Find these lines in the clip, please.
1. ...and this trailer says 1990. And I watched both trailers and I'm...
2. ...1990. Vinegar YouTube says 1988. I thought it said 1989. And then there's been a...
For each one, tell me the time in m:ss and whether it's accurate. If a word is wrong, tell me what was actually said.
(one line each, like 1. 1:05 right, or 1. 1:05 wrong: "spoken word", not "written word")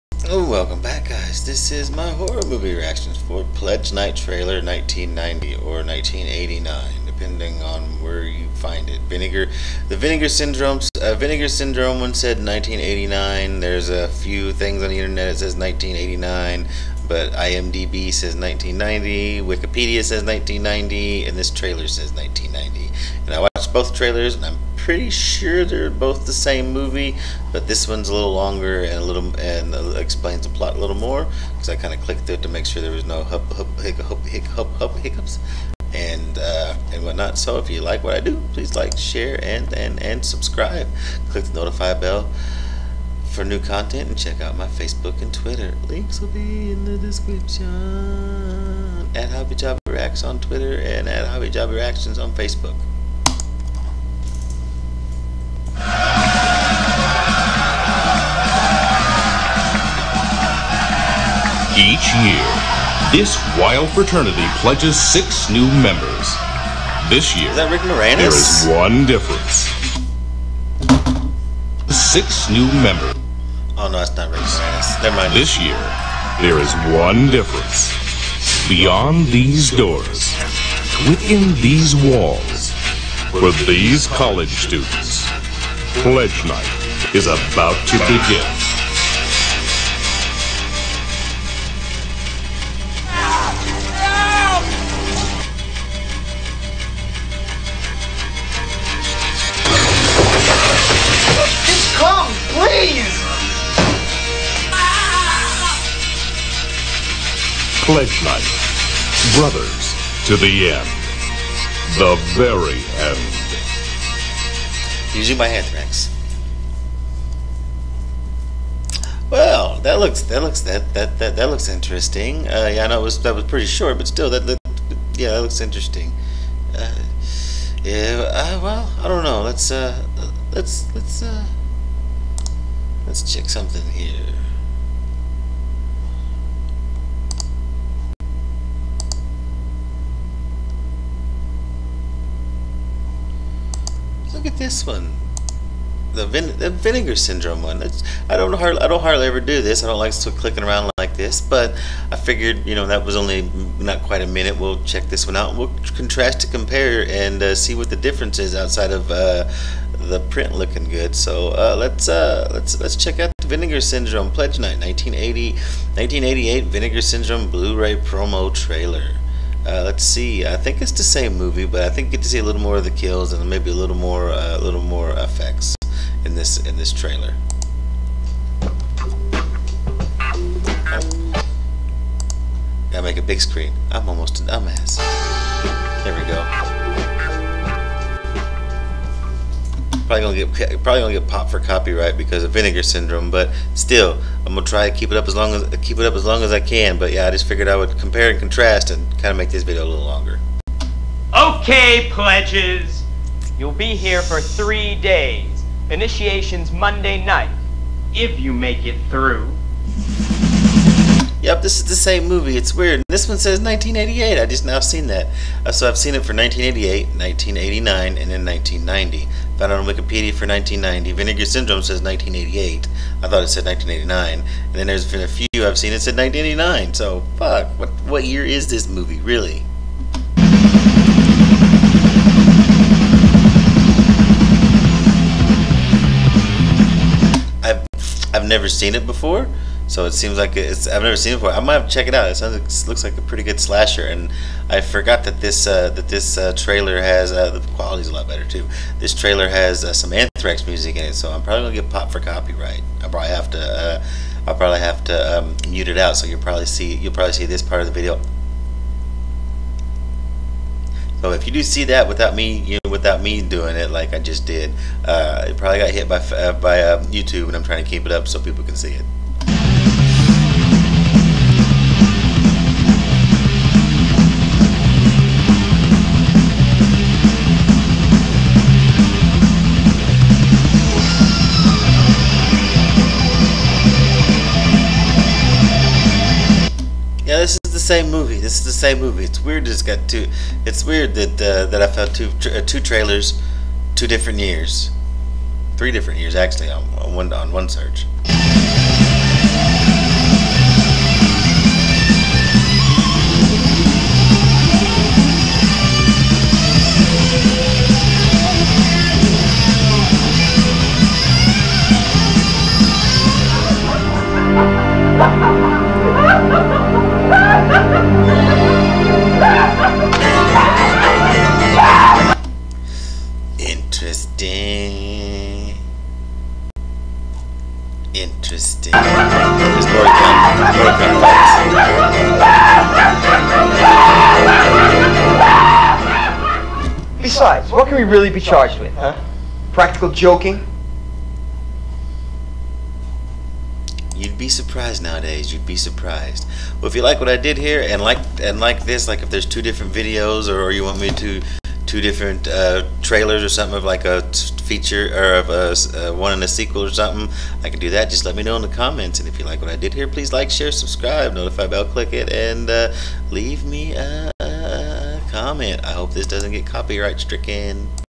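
1. 0:21 right
2. 3:40 wrong: "Syndrome", not "YouTube".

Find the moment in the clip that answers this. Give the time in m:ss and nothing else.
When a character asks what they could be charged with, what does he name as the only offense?
5:39.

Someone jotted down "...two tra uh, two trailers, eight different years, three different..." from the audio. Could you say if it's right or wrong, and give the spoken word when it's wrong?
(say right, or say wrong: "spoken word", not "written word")
wrong: "two", not "eight".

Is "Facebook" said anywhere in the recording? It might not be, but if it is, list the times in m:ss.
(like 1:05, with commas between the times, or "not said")
0:44, 0:52.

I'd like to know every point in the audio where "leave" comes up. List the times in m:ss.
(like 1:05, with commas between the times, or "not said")
6:03.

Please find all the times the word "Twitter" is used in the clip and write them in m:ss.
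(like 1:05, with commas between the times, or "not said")
0:45, 0:50.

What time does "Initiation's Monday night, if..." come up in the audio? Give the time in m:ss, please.
3:25.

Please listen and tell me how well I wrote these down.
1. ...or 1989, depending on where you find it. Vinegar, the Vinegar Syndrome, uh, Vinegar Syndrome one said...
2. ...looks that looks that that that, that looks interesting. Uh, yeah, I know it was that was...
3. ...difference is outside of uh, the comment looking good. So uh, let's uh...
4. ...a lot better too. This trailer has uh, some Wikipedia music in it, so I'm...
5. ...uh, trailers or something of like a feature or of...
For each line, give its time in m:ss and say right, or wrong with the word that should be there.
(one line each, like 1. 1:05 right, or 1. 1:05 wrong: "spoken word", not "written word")
1. 0:05 right
2. 1:59 right
3. 2:37 wrong: "print", not "comment"
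4. 4:08 wrong: "Anthrax", not "Wikipedia"
5. 5:52 right.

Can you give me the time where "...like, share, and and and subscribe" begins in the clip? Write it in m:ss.
0:38.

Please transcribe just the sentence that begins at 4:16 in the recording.
So you'll probably see you'll probably see this part of the video.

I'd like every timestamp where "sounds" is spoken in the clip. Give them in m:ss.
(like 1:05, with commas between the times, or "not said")
4:02.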